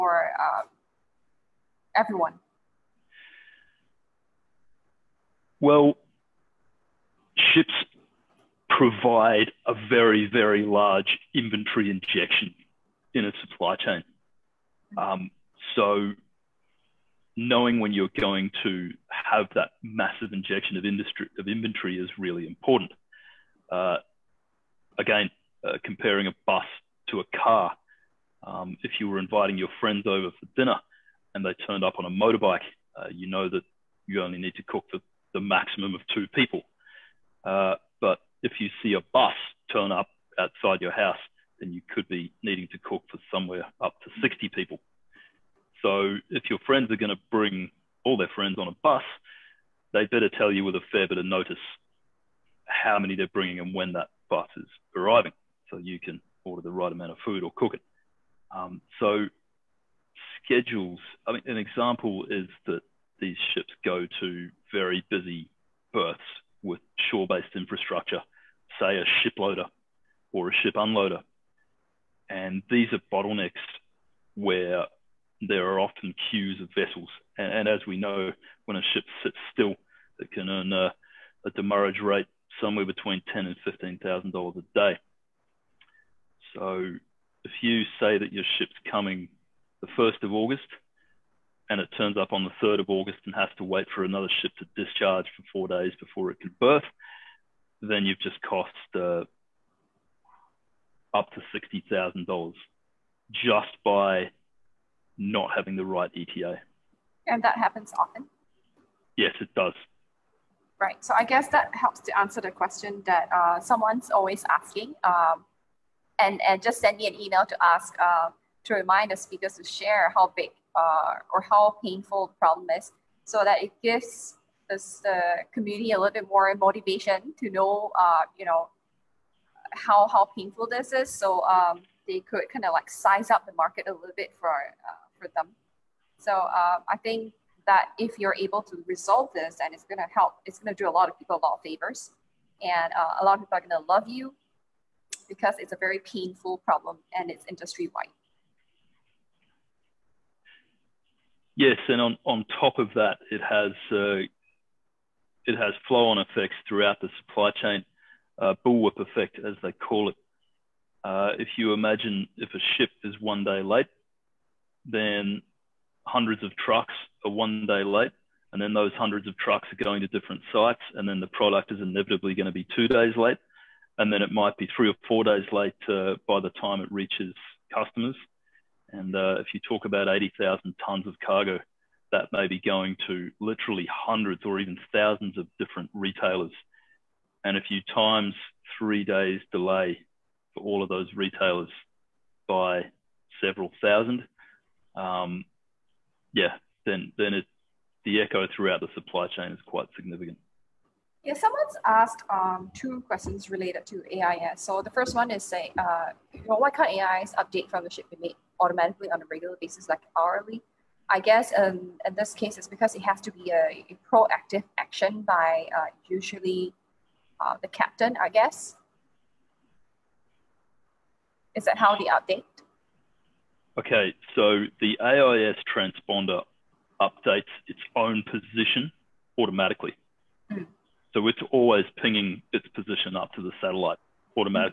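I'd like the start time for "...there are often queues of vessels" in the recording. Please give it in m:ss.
1:15.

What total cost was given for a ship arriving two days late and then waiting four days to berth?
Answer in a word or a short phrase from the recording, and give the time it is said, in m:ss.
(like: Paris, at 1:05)
$60,000, at 1:41.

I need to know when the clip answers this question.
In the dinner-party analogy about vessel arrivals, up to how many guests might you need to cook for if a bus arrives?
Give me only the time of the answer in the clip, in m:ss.
0:44.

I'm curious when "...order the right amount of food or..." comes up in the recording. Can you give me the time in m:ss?
0:56.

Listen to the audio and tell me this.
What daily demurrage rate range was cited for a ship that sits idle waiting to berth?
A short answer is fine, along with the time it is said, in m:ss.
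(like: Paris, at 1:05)
$10,000 to $15,000, at 1:23.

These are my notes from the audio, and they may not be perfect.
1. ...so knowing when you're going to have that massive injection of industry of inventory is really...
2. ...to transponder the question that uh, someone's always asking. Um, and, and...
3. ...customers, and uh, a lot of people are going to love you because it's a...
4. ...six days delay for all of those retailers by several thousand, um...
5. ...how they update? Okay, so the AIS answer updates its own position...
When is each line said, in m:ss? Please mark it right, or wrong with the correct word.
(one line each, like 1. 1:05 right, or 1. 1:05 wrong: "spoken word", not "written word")
1. 0:15 right
2. 1:52 wrong: "answer", not "transponder"
3. 2:21 wrong: "favors", not "customers"
4. 3:08 wrong: "three", not "six"
5. 3:41 wrong: "transponder", not "answer".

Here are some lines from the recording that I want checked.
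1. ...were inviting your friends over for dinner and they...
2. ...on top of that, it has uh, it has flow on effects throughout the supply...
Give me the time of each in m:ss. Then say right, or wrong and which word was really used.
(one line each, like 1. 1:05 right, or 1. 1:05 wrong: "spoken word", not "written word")
1. 0:29 right
2. 2:32 right.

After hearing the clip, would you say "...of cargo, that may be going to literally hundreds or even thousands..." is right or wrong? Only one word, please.
right.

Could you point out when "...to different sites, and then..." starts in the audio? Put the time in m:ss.
2:50.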